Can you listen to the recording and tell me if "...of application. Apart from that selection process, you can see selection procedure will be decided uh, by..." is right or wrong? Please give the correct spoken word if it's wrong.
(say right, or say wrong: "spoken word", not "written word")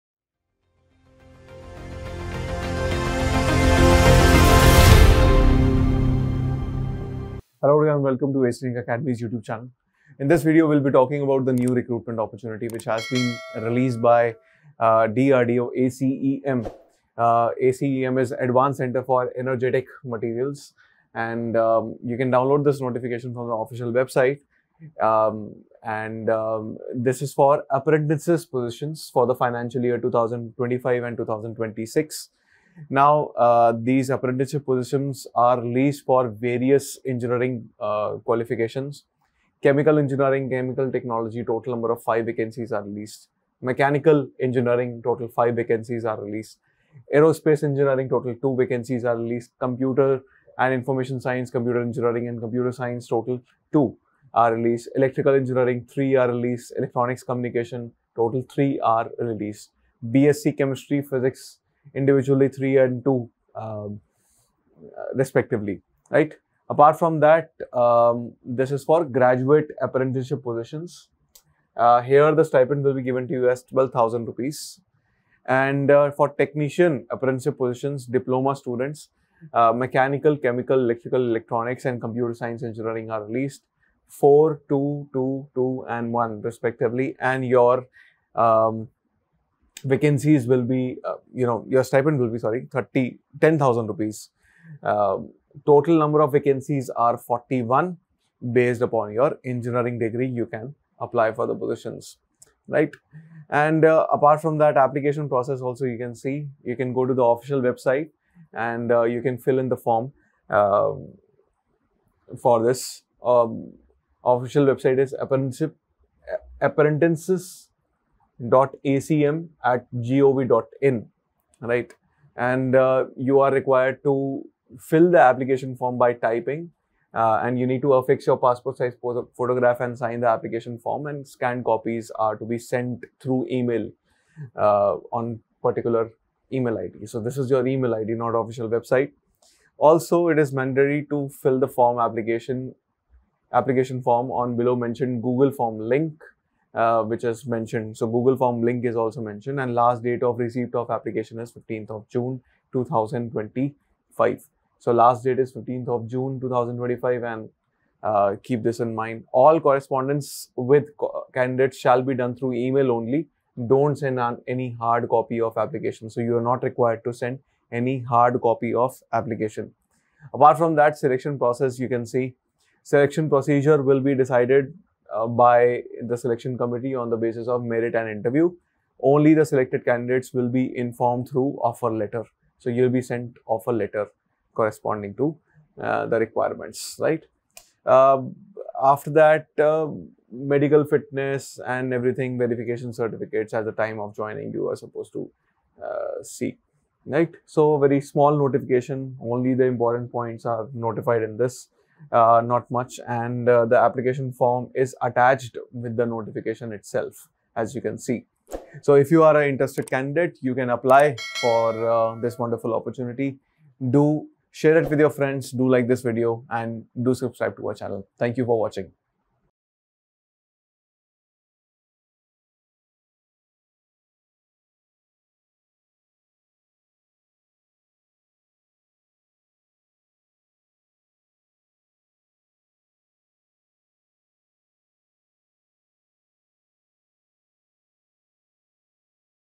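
right.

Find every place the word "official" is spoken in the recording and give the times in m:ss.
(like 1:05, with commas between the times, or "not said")
0:23, 1:47, 1:54, 2:18.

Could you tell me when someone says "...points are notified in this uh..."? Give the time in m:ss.
3:20.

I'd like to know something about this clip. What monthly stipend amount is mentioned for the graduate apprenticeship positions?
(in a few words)
12,000 rupees.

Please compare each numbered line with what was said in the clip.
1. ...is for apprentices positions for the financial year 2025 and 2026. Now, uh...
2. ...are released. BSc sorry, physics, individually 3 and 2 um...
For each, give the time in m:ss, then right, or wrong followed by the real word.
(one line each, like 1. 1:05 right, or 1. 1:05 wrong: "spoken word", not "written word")
1. 0:27 right
2. 0:58 wrong: "chemistry", not "sorry".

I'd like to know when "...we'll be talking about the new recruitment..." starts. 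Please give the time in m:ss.
0:10.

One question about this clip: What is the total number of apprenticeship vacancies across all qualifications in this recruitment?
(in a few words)
41.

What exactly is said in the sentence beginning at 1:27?
And your um, vacancies will be, uh, you know, your stipend will be, sorry, 30, 10,000 rupees.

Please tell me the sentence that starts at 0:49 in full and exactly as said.
Computer and information science, computer engineering and computer science, total two are released.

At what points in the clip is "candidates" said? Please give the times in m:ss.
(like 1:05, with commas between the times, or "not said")
2:41, 2:59, 3:29.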